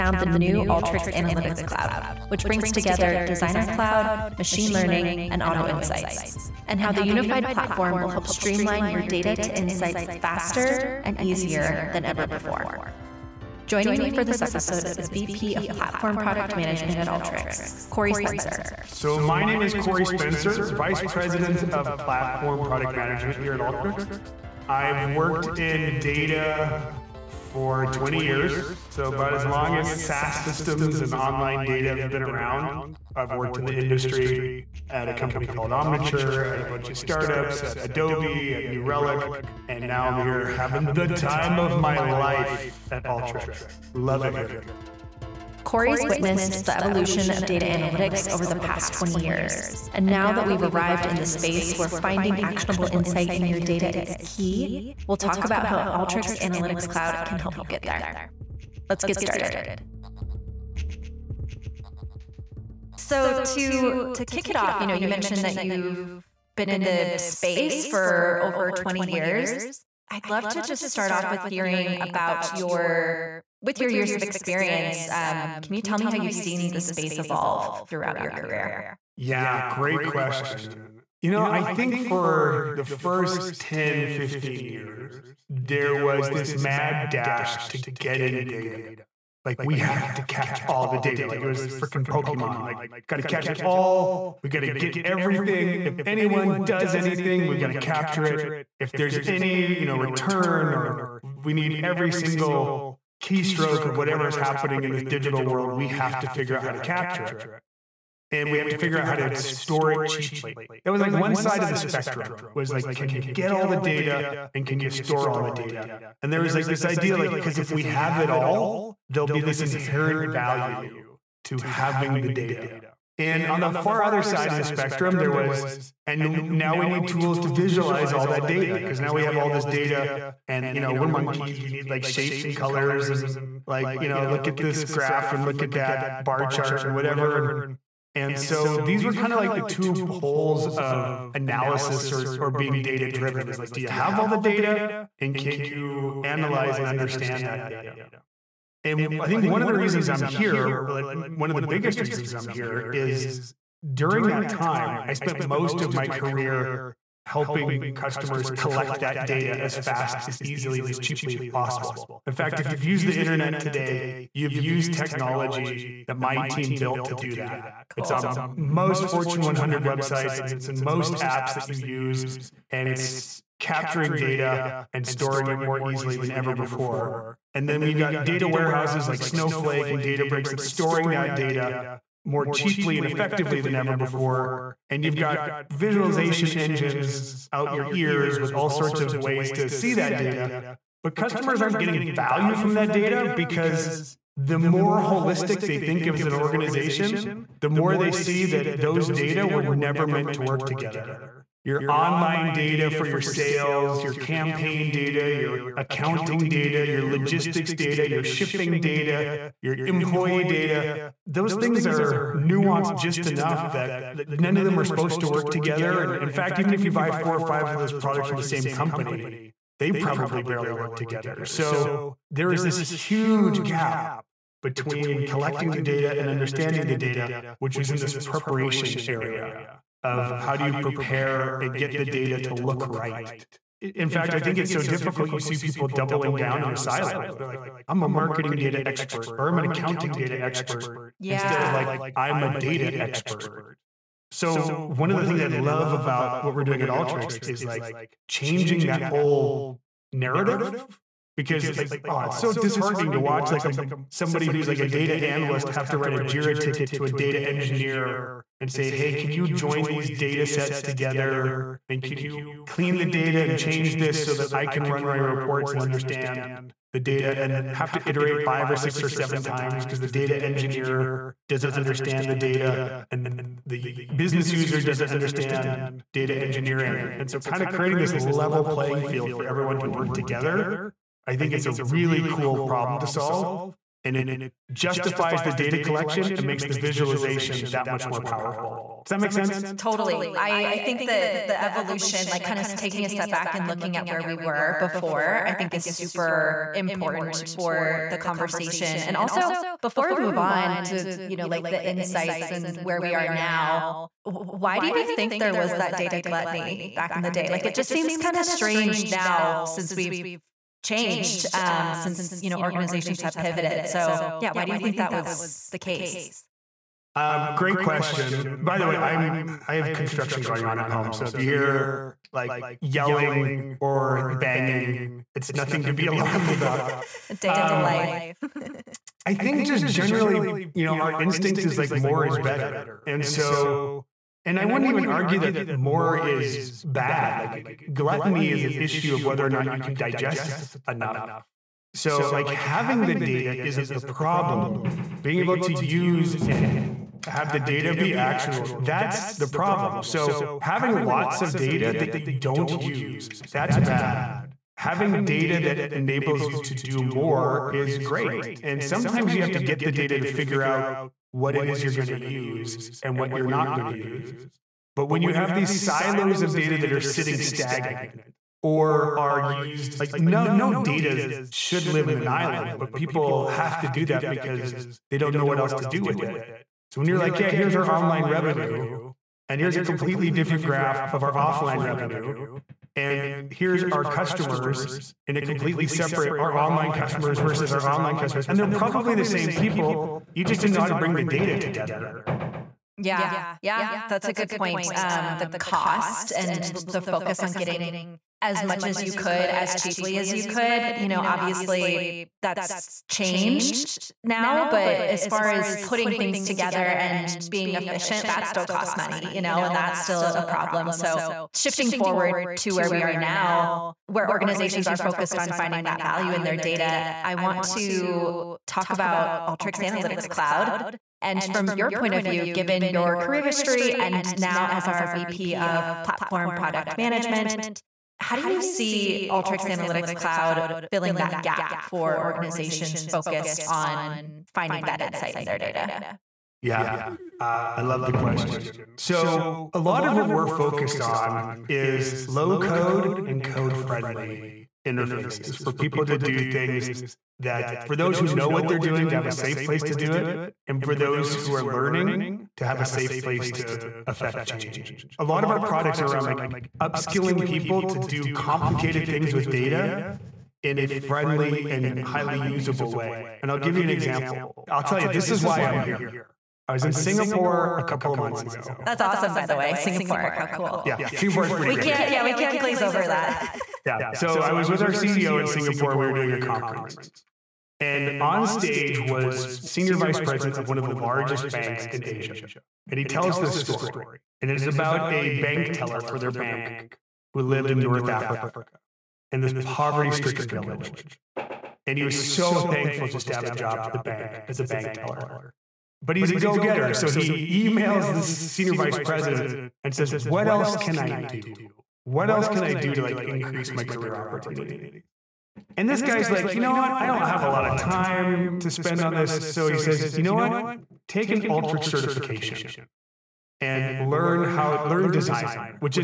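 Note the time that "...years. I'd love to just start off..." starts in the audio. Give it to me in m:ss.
1:09.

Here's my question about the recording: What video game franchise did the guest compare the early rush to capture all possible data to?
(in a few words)
Pokemon.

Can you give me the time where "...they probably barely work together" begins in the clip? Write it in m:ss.
3:39.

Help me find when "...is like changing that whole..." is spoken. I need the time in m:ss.
4:07.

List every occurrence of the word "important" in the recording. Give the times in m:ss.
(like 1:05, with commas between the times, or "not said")
4:56.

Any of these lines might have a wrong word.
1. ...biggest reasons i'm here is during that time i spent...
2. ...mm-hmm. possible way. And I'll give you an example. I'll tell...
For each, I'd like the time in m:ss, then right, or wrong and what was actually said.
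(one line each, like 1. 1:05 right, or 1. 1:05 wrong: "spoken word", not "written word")
1. 2:31 right
2. 7:42 wrong: "usable", not "possible".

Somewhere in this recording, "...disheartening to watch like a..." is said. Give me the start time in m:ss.
4:12.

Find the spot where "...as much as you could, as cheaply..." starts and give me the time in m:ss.
6:38.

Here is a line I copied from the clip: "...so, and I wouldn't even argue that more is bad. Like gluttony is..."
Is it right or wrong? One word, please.
right.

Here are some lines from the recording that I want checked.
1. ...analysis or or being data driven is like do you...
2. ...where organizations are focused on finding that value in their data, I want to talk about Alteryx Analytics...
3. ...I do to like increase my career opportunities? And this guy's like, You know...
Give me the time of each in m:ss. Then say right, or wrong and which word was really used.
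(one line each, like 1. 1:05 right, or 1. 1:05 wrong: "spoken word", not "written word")
1. 2:21 right
2. 6:54 right
3. 8:22 right.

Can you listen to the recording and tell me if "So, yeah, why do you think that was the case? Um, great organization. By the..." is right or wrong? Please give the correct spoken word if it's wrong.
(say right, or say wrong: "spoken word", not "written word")
wrong: "question", not "organization".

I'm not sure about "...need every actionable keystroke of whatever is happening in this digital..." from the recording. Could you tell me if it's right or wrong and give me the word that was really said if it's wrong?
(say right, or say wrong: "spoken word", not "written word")
wrong: "single", not "actionable".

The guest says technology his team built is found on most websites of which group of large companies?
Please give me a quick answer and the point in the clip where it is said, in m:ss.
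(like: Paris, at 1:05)
Fortune 100, at 2:49.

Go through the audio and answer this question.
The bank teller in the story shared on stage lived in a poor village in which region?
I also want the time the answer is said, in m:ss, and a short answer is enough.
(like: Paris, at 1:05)
North Africa, at 8:07.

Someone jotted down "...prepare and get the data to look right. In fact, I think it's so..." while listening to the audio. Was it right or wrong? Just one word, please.
right.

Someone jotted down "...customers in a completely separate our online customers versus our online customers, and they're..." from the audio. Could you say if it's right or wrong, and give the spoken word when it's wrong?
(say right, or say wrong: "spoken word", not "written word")
right.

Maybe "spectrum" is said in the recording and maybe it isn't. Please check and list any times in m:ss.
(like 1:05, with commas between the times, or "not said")
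1:51, 2:04.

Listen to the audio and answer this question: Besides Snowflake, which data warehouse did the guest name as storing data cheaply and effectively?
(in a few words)
Databricks.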